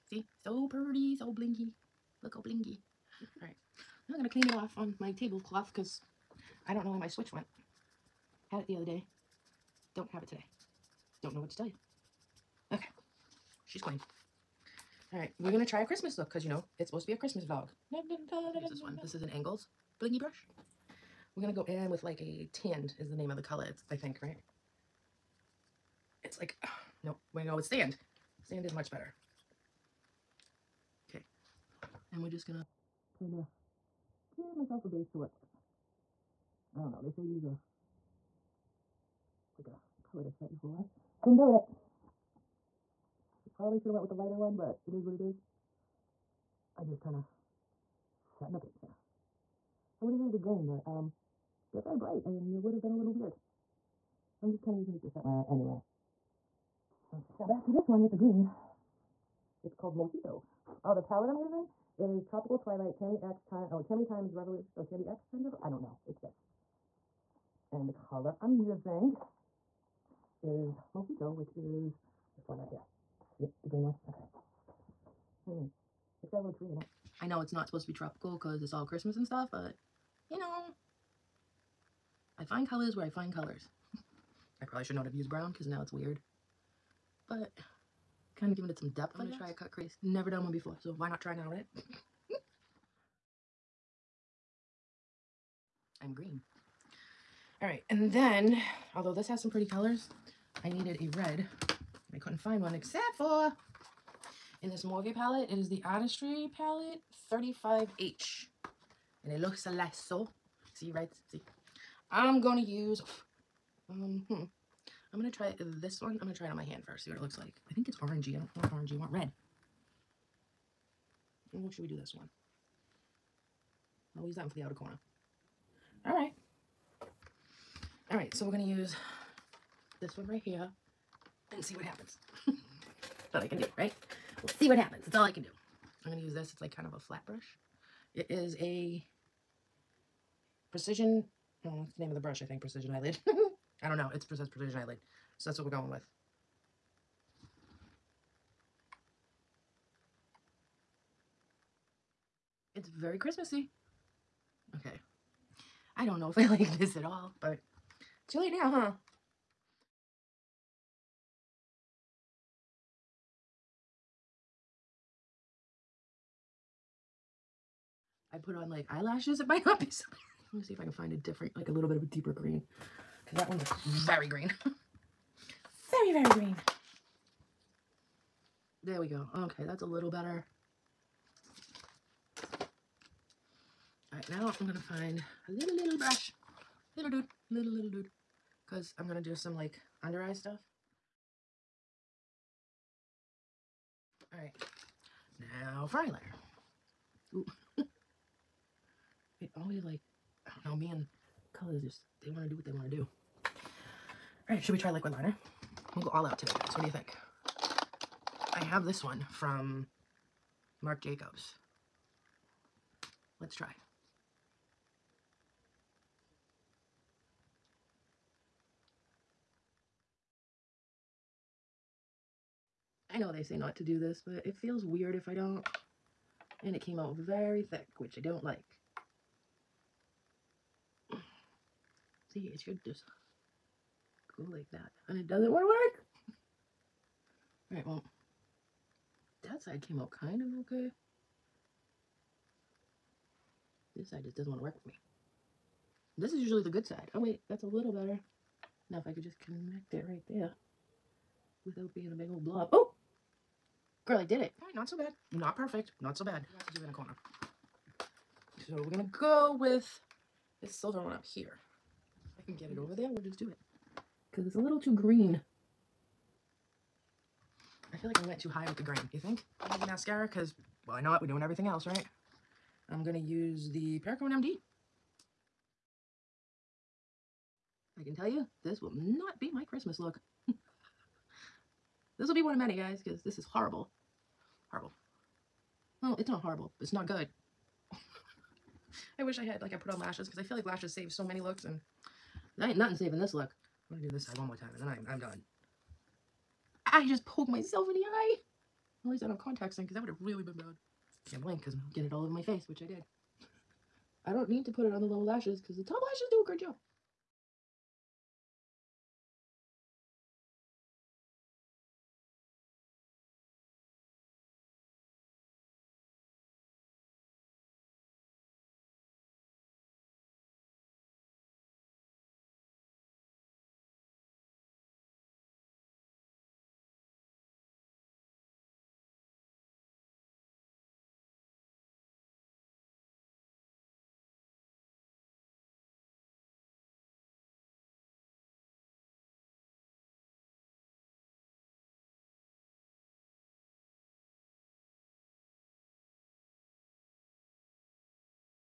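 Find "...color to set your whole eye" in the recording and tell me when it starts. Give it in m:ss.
0:40.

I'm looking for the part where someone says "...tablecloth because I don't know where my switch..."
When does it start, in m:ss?
0:05.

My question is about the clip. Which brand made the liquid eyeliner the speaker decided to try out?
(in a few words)
Marc Jacobs.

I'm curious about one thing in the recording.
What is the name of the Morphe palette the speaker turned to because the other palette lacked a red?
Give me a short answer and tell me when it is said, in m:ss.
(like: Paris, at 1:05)
Artistry palette 35H, at 1:45.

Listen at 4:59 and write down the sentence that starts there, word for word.
At least I don't have contacts in, because that would have really been bad.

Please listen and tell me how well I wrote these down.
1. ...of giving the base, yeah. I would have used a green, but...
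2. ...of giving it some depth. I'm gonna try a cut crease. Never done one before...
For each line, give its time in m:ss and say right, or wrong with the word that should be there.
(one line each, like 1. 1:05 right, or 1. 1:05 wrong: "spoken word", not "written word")
1. 0:47 wrong: "setting", not "giving"
2. 1:28 right.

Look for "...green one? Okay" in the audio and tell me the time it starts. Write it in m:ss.
1:13.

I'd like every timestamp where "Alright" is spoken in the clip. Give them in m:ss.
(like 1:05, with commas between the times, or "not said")
0:03, 3:57, 4:14.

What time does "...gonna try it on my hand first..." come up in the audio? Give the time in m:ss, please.
1:56.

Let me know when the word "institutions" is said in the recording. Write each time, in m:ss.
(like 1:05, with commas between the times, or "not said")
not said.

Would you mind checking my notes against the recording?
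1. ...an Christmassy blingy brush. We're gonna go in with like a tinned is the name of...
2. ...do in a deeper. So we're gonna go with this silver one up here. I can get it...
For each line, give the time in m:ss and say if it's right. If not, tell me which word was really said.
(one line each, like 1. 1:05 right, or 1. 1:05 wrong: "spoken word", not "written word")
1. 0:19 wrong: "Angles", not "Christmassy"
2. 4:16 wrong: "corner", not "deeper".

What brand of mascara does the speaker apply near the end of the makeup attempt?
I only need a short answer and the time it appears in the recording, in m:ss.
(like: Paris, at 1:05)
Perricone MD, at 4:33.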